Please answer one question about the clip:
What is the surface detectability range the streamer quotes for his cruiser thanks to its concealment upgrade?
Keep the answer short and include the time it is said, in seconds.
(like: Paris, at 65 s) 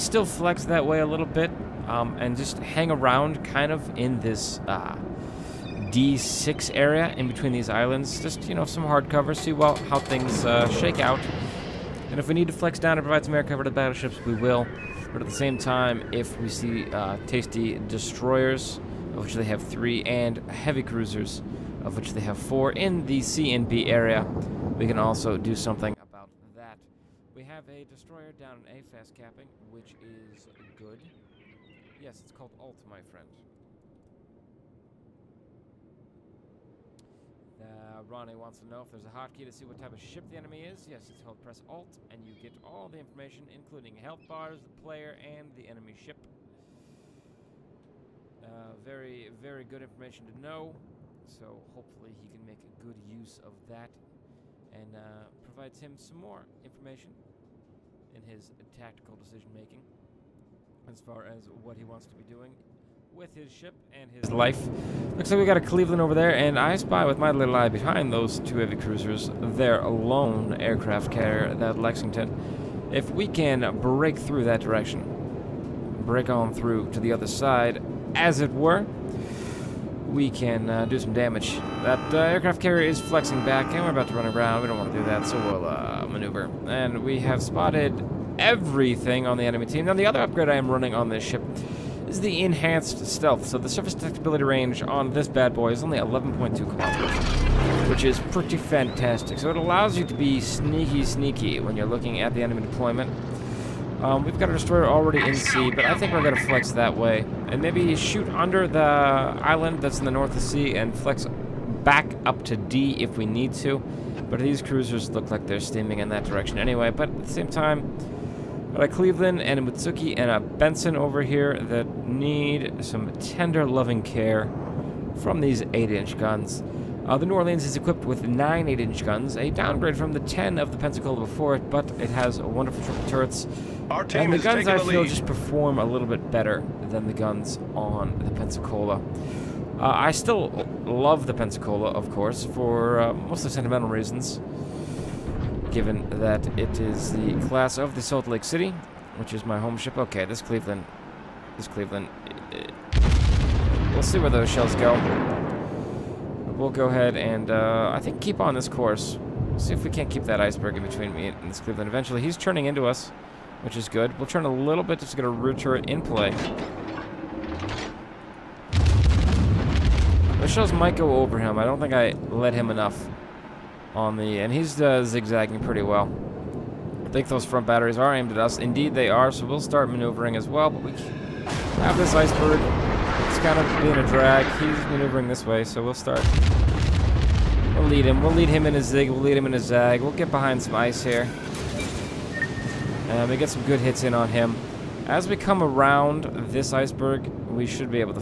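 11.2 kilometers, at 95 s.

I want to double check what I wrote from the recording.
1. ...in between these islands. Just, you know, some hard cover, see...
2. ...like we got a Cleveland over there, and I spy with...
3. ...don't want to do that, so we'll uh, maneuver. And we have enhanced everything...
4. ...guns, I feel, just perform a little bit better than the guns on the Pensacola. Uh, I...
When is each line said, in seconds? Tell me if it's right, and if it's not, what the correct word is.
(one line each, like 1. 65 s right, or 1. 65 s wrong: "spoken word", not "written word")
1. 7 s right
2. 65 s right
3. 84 s wrong: "spotted", not "enhanced"
4. 134 s right.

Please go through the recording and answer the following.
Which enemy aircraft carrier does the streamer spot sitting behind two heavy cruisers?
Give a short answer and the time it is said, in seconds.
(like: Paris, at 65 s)
Lexington, at 71 s.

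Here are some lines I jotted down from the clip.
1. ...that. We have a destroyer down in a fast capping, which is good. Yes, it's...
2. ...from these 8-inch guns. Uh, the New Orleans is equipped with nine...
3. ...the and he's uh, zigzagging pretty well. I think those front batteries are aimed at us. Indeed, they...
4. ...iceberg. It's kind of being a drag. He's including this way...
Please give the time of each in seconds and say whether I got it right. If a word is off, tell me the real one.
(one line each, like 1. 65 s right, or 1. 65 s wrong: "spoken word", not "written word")
1. 26 s right
2. 125 s right
3. 174 s right
4. 182 s wrong: "maneuvering", not "including".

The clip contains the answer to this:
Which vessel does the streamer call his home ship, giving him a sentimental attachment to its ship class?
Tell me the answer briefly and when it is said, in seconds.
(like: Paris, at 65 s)
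Salt Lake City, at 148 s.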